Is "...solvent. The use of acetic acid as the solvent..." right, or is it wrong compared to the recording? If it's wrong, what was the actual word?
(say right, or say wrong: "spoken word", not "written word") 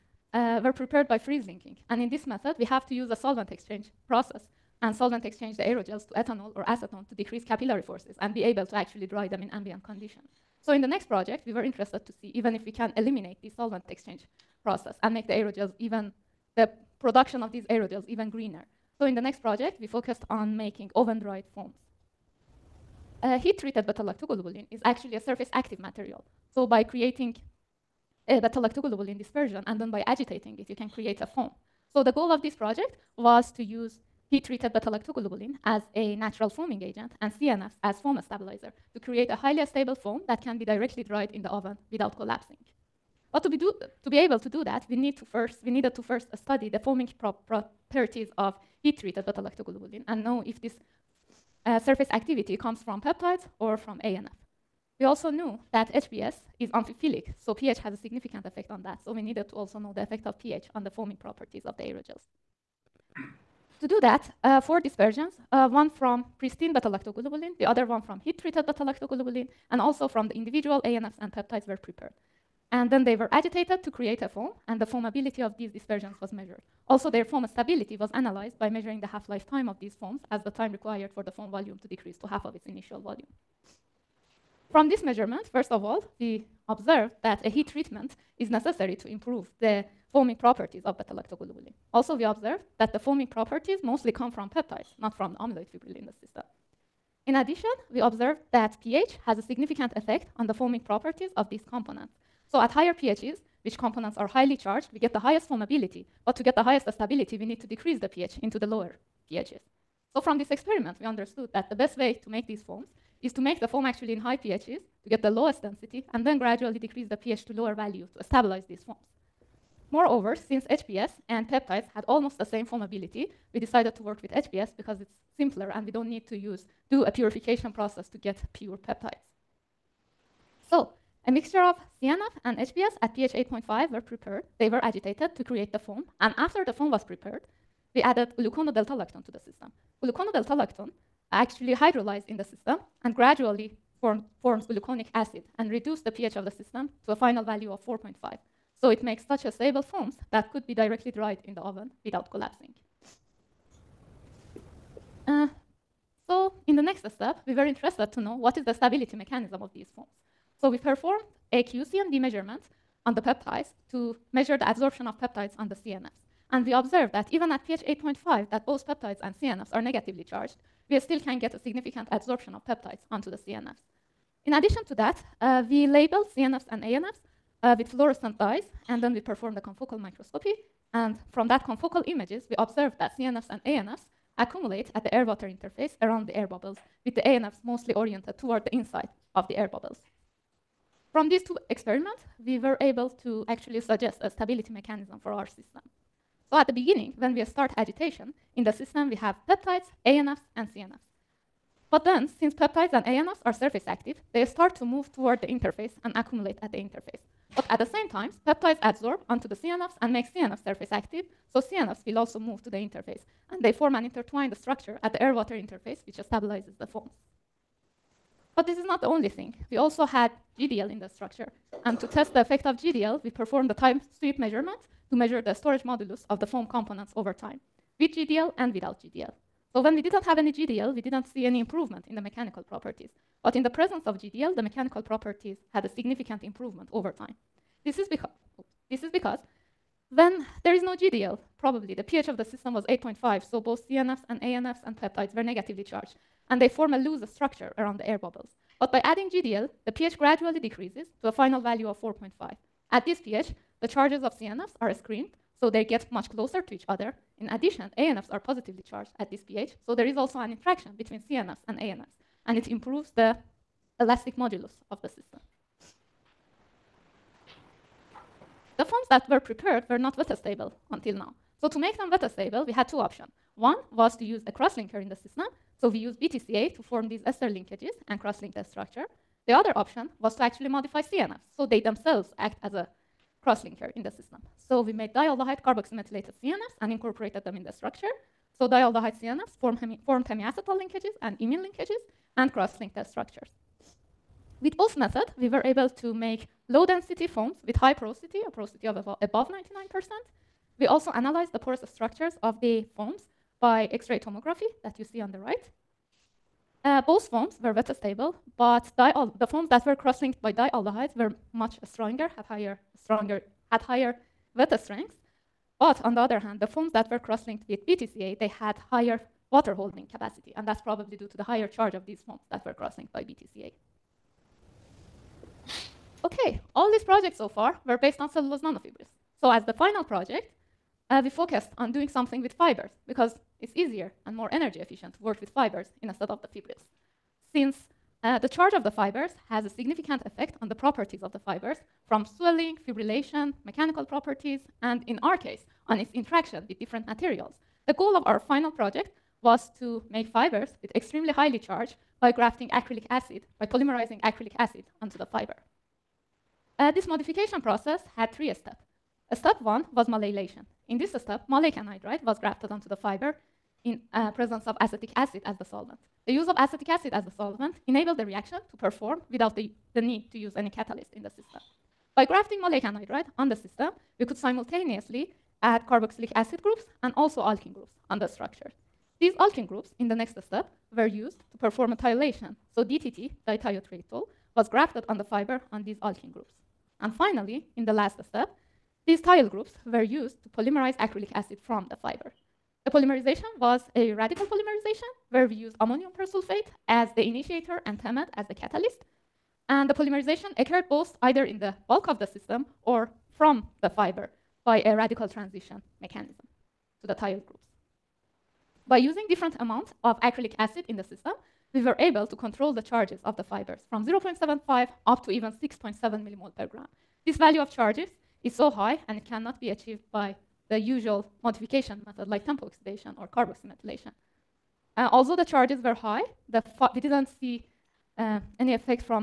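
right.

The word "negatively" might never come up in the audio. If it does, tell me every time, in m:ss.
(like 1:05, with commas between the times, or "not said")
2:49, 4:05.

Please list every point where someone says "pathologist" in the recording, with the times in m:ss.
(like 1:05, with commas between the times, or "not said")
not said.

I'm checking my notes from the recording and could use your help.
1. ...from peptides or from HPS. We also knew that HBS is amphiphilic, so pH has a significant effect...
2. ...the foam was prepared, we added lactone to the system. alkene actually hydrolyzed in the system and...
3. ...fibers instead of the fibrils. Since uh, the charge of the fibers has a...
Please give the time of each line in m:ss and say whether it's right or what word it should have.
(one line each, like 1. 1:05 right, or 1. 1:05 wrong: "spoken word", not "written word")
1. 0:52 wrong: "ANF", not "HPS"
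2. 2:16 wrong: "lactone", not "alkene"
3. 5:35 right.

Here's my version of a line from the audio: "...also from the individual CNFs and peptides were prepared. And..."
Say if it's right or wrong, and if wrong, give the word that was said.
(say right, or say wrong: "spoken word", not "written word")
wrong: "ANFs", not "CNFs".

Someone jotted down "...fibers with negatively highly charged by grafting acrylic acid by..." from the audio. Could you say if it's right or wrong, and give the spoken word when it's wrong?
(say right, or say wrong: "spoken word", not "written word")
wrong: "extremely", not "negatively".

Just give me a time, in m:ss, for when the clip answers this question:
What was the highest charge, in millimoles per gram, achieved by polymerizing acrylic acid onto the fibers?
6:55.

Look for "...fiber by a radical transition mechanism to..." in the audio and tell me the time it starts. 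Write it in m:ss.
6:43.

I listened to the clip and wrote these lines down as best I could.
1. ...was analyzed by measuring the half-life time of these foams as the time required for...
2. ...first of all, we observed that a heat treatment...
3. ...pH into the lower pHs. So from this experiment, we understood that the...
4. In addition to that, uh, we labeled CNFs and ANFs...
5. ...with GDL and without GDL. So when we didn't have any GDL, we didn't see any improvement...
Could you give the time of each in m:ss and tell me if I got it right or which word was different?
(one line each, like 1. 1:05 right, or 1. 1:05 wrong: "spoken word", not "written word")
1. 1:17 right
2. 1:25 right
3. 1:48 right
4. 2:54 right
5. 3:47 right.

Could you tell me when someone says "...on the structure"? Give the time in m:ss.
6:18.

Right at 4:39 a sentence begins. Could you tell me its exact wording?
The other option was to actually modify CNFs, so they themselves act as a cross-linker in the system.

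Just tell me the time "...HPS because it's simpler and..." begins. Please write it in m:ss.
2:04.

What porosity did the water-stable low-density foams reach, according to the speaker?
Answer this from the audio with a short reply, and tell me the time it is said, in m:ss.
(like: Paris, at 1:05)
above 99%, at 4:58.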